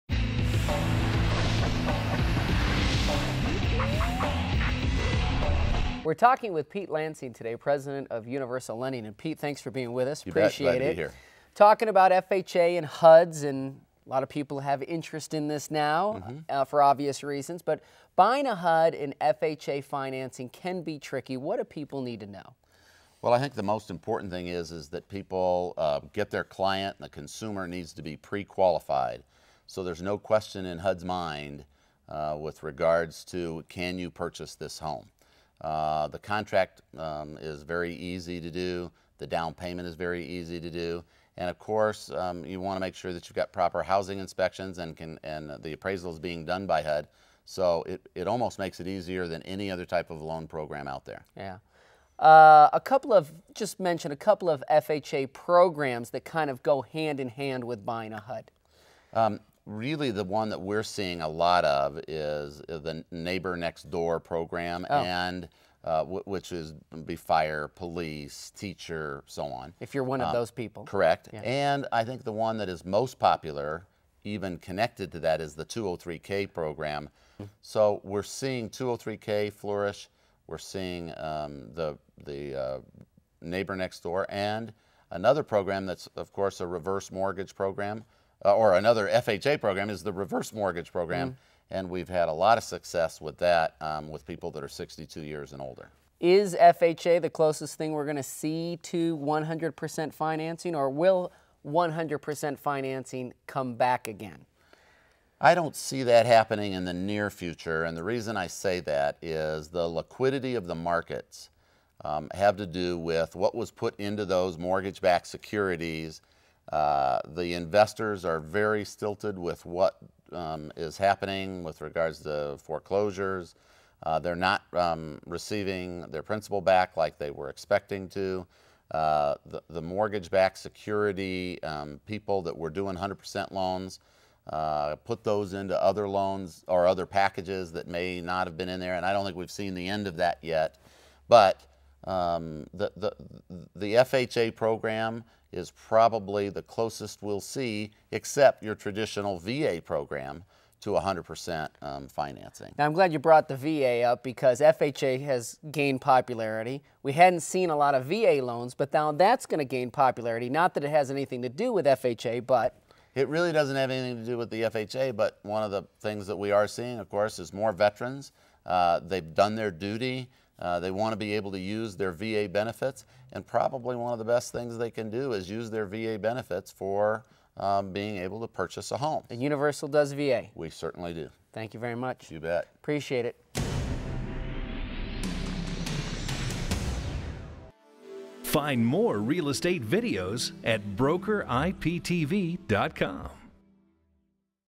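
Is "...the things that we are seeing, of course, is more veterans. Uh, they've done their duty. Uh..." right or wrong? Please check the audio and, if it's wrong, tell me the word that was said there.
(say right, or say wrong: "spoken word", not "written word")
right.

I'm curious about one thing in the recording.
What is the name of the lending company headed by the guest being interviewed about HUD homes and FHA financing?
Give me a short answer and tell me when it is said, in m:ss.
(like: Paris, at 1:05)
Universal Lending, at 0:08.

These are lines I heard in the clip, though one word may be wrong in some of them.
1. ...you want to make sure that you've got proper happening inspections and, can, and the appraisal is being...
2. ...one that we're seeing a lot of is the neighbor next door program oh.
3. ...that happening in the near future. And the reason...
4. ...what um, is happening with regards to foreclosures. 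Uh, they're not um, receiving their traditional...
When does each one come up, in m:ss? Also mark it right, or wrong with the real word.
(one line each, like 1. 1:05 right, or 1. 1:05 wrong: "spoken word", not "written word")
1. 0:42 wrong: "housing", not "happening"
2. 1:00 right
3. 1:46 right
4. 1:59 wrong: "principal", not "traditional".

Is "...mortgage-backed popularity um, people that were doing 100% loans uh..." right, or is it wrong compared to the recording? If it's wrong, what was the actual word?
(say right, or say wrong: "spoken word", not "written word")
wrong: "security", not "popularity".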